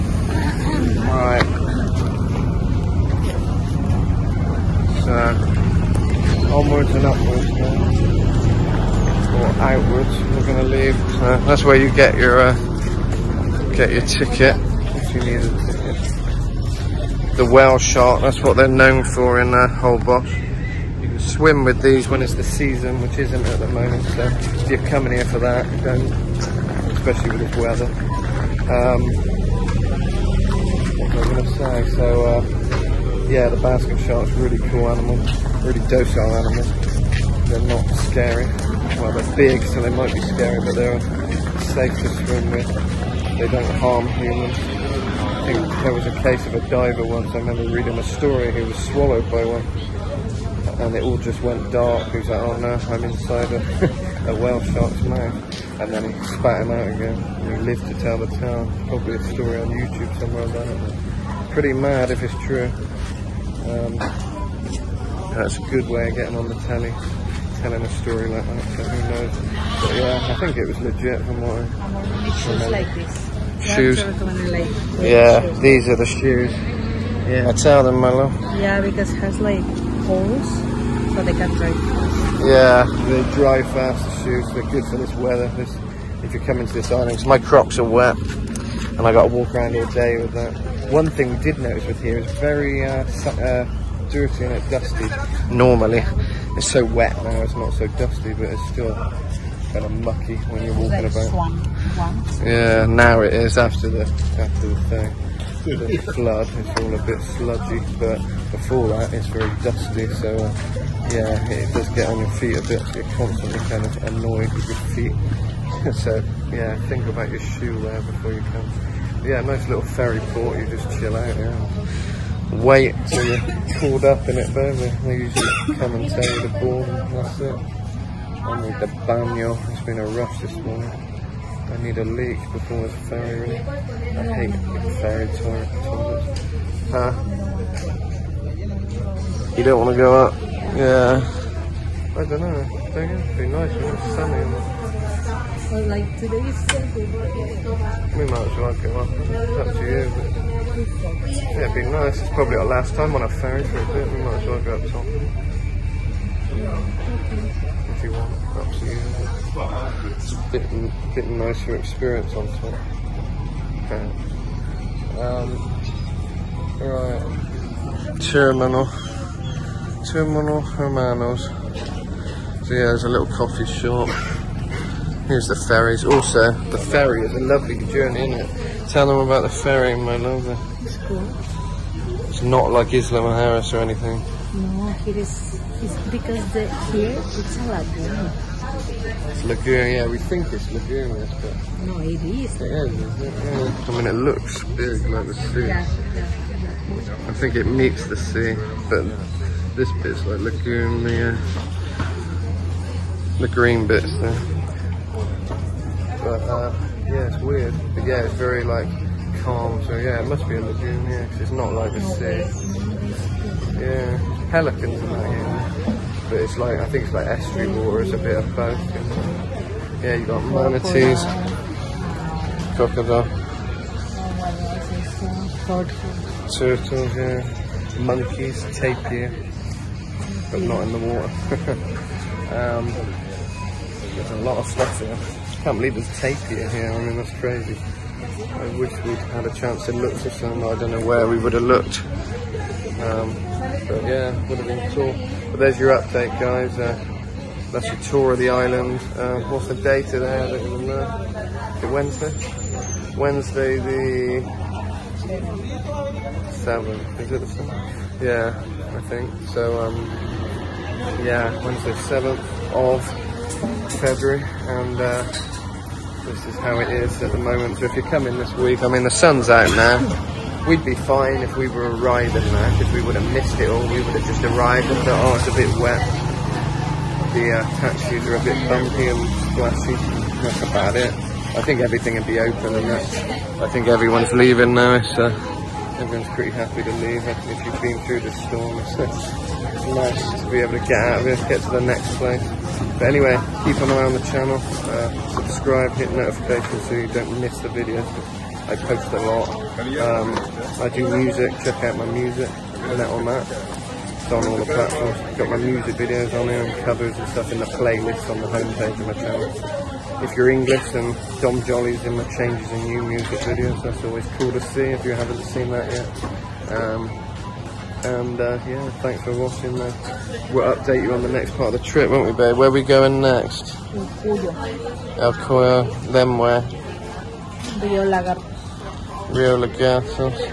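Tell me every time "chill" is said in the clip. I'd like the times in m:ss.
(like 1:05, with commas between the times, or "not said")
2:00.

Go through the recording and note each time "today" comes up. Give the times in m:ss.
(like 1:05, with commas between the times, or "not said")
2:26, 4:10.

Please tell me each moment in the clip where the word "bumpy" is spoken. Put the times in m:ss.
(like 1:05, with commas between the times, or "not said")
4:38.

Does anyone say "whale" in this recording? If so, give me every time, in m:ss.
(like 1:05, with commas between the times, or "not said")
0:17, 0:54.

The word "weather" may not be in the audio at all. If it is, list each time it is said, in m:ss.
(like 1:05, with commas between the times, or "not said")
0:27, 1:25.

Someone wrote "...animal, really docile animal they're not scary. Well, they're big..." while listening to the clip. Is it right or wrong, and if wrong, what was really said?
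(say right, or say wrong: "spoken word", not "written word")
right.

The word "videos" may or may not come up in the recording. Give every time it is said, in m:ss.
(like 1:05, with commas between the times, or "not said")
4:57, 5:05, 5:13.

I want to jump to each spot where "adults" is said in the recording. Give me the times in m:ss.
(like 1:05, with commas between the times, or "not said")
not said.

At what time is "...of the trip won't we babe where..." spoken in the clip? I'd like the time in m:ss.
5:21.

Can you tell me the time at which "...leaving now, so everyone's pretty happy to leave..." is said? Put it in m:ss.
4:44.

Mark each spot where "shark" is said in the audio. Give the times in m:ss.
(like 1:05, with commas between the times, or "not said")
0:17, 0:33, 0:54.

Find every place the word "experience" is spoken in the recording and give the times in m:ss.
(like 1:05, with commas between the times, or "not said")
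2:41.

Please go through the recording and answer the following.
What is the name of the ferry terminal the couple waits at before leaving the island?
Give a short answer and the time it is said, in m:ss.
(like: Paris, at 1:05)
Terminal Hermanos, at 2:50.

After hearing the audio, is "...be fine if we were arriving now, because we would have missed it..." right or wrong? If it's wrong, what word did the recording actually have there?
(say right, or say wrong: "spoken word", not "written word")
right.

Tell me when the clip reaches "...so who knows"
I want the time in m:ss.
1:08.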